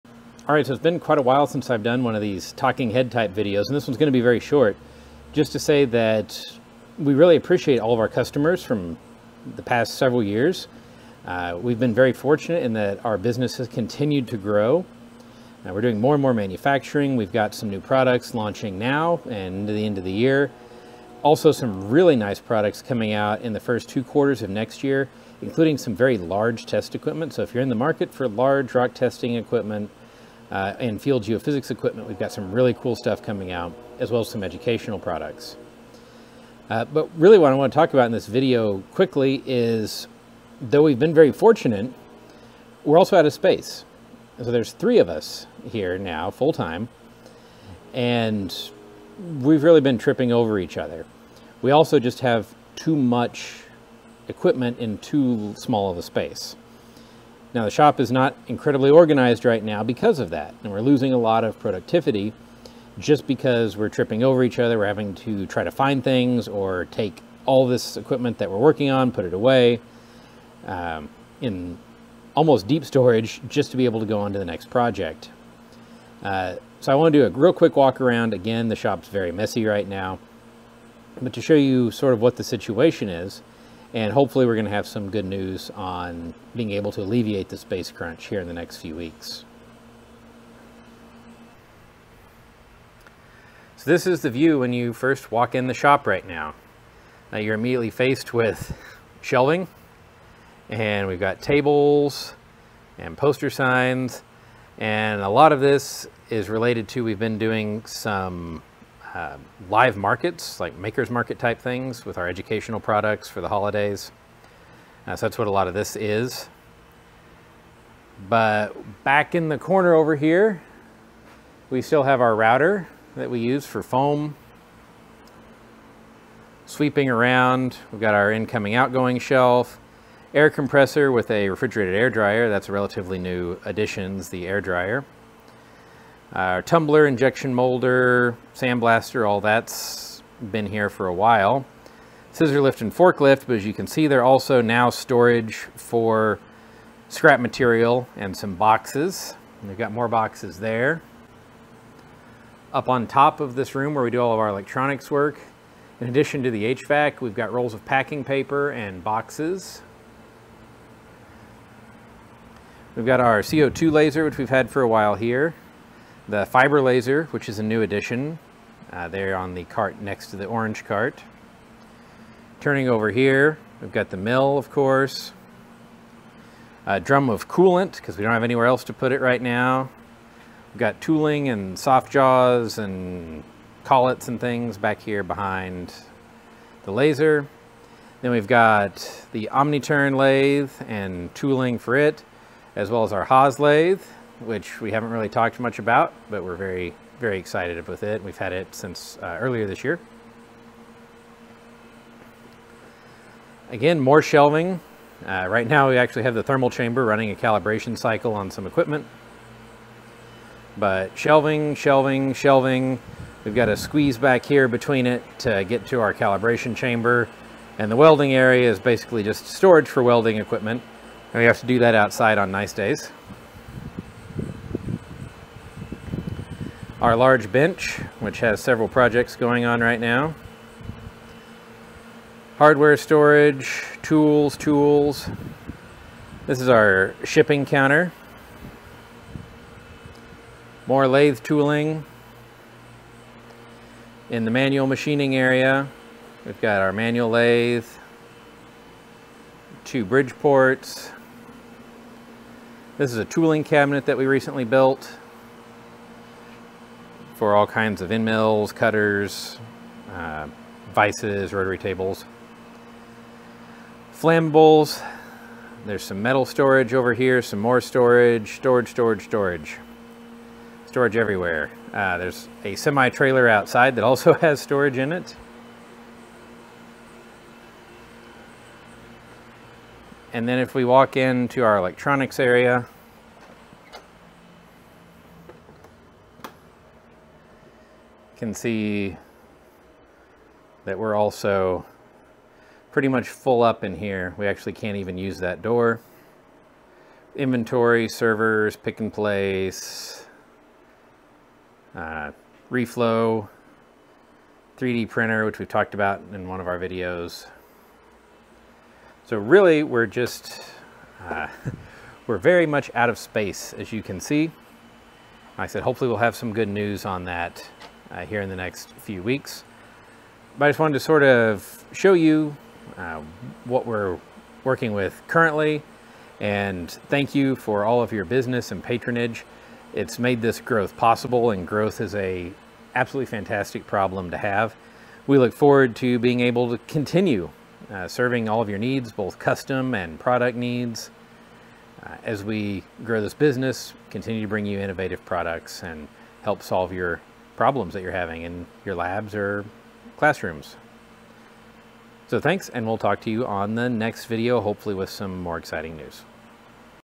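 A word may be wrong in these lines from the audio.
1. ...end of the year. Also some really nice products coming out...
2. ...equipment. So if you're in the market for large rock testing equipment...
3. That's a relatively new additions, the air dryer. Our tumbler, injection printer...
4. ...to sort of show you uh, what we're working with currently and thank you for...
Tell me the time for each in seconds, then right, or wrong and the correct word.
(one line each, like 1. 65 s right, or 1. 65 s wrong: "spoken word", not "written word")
1. 19 s right
2. 26 s right
3. 132 s wrong: "molder", not "printer"
4. 320 s right.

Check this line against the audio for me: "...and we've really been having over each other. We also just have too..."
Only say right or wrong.
wrong.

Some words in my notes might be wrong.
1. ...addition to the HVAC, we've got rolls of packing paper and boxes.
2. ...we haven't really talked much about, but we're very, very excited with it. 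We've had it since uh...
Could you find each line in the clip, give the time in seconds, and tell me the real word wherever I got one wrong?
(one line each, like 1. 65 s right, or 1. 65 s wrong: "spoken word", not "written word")
1. 156 s right
2. 194 s right.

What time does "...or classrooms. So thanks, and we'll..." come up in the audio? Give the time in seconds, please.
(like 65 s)
349 s.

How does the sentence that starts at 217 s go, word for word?
And the welding area is basically just storage for welding equipment.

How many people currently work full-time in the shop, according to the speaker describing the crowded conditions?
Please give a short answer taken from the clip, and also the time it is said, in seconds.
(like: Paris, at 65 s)
3, at 44 s.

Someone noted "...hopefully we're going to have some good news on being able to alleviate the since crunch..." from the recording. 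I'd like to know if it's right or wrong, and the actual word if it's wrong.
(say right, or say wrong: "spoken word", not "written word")
wrong: "space", not "since".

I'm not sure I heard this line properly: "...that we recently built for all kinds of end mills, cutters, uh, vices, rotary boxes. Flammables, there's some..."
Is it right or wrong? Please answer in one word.
wrong.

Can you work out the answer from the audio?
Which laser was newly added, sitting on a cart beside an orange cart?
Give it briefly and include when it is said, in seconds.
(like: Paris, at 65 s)
fiber laser, at 166 s.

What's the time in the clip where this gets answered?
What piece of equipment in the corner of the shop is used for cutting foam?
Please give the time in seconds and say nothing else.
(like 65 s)
122 s.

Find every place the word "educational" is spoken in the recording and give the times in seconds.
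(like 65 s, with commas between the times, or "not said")
34 s, 112 s.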